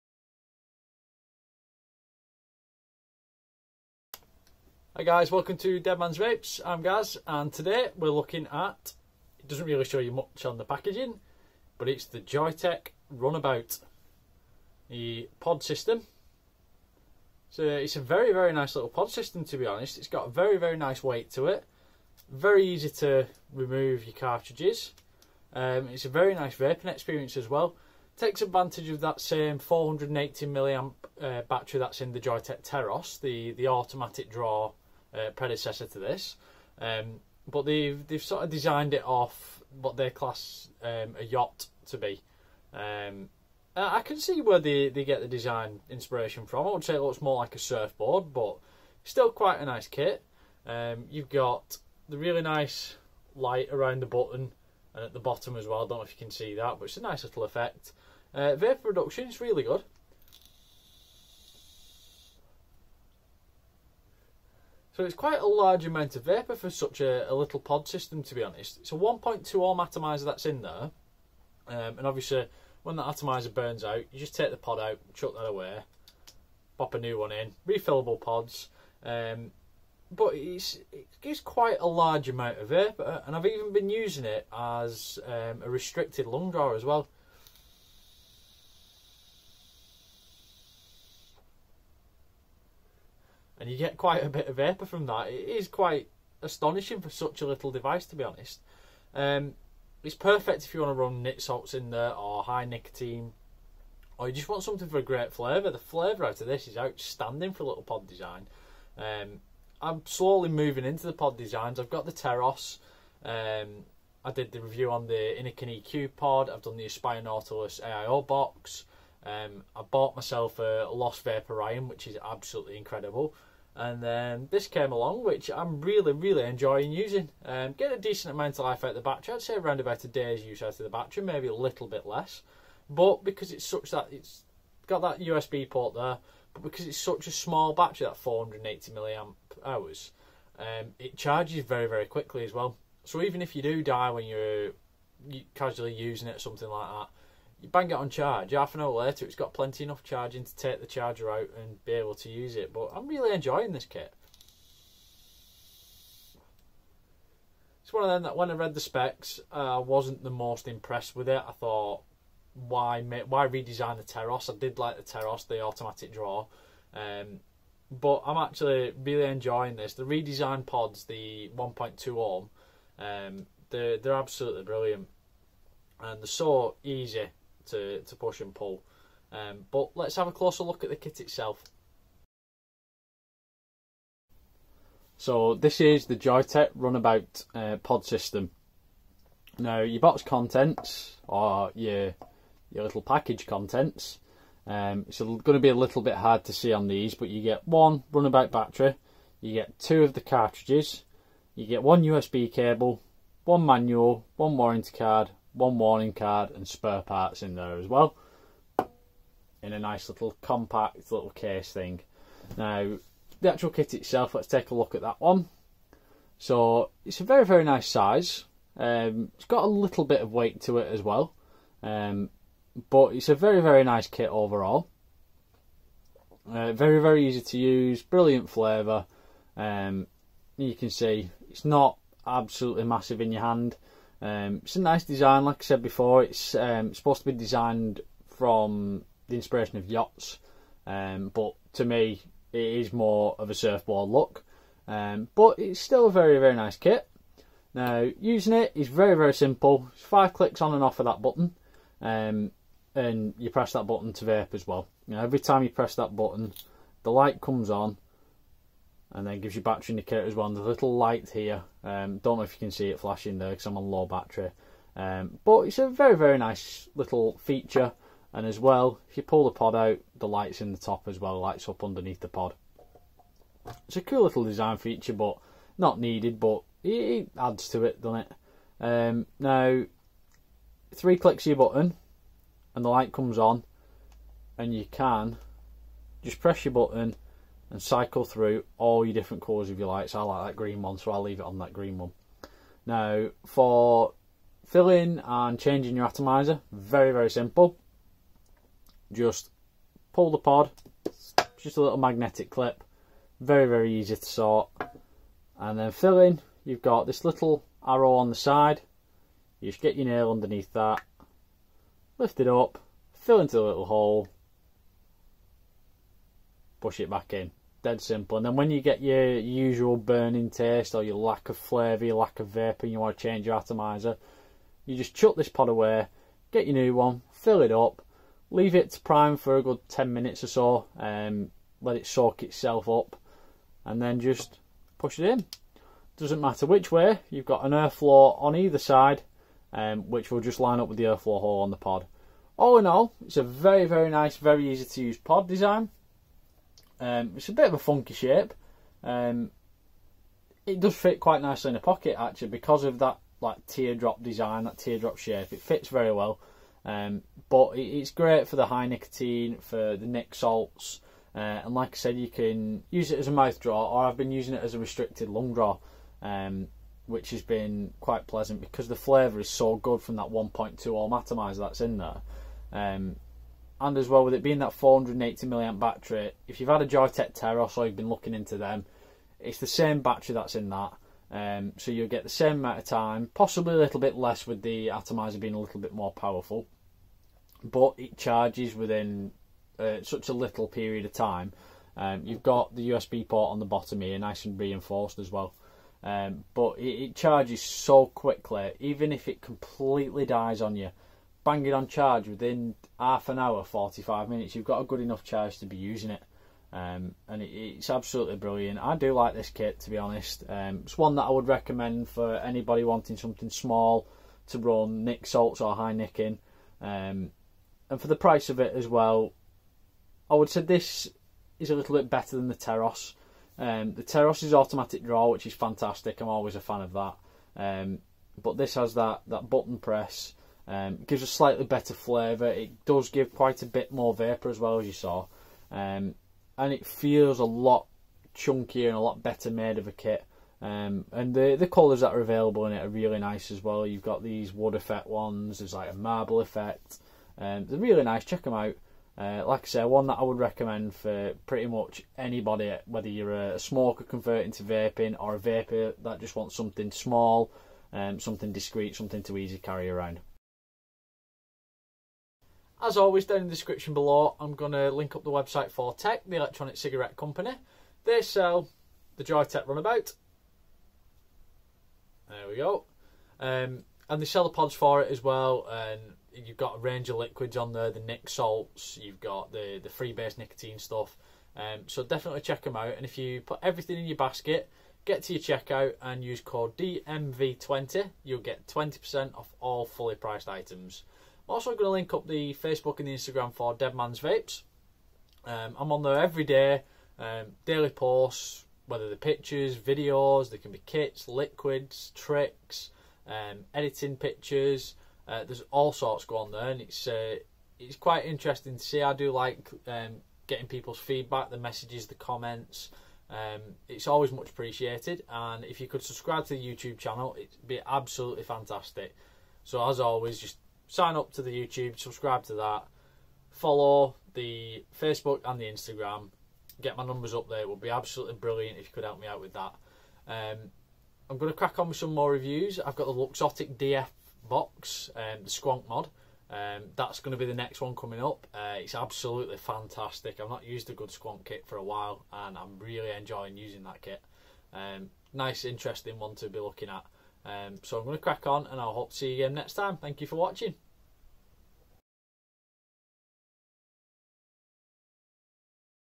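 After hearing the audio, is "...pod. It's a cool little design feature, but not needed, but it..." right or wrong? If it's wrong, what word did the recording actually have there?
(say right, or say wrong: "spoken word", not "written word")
right.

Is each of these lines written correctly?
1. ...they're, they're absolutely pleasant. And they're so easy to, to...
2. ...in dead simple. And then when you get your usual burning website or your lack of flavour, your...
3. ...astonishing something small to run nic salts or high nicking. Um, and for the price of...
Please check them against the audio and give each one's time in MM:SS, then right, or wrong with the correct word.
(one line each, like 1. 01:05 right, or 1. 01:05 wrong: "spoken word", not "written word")
1. 02:53 wrong: "brilliant", not "pleasant"
2. 05:17 wrong: "taste", not "website"
3. 06:52 wrong: "wanting", not "astonishing".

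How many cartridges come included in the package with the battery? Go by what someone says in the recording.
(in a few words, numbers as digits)
2.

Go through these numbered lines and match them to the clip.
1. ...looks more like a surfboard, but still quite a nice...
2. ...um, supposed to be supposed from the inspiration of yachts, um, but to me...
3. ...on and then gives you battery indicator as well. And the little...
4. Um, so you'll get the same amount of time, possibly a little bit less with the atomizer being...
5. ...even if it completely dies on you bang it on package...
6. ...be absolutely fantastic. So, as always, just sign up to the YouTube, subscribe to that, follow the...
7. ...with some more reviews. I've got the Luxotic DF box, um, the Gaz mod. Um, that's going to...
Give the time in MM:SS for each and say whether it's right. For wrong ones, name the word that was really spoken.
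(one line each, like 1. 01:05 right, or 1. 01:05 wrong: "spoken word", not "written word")
1. 00:47 right
2. 03:56 wrong: "designed", not "supposed"
3. 04:17 right
4. 06:21 right
5. 06:38 wrong: "charge", not "package"
6. 08:37 right
7. 08:51 wrong: "Squonk", not "Gaz".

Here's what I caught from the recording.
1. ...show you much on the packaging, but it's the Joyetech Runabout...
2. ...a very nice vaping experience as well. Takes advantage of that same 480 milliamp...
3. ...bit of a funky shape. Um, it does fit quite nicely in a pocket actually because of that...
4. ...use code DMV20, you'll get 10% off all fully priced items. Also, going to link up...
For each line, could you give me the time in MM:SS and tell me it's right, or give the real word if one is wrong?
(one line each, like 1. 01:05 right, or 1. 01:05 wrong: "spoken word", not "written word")
1. 00:09 right
2. 00:26 right
3. 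05:47 right
4. 08:06 wrong: "20", not "10".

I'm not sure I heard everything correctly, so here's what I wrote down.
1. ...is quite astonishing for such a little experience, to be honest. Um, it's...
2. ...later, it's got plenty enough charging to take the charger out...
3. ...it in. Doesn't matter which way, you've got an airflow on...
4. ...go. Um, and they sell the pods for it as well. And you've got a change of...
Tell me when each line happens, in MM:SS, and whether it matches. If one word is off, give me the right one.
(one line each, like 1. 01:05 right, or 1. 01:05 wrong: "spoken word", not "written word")
1. 01:35 wrong: "device", not "experience"
2. 02:28 right
3. 05:35 right
4. 07:52 wrong: "range", not "change".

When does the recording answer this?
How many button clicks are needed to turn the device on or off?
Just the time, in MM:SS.
04:10.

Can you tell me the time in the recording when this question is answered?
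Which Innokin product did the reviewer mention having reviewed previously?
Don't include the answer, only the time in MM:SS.
01:55.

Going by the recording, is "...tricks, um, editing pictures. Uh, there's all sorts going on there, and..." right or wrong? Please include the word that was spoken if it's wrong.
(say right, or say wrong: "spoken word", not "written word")
right.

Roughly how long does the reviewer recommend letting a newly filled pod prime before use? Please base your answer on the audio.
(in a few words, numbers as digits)
10 minutes.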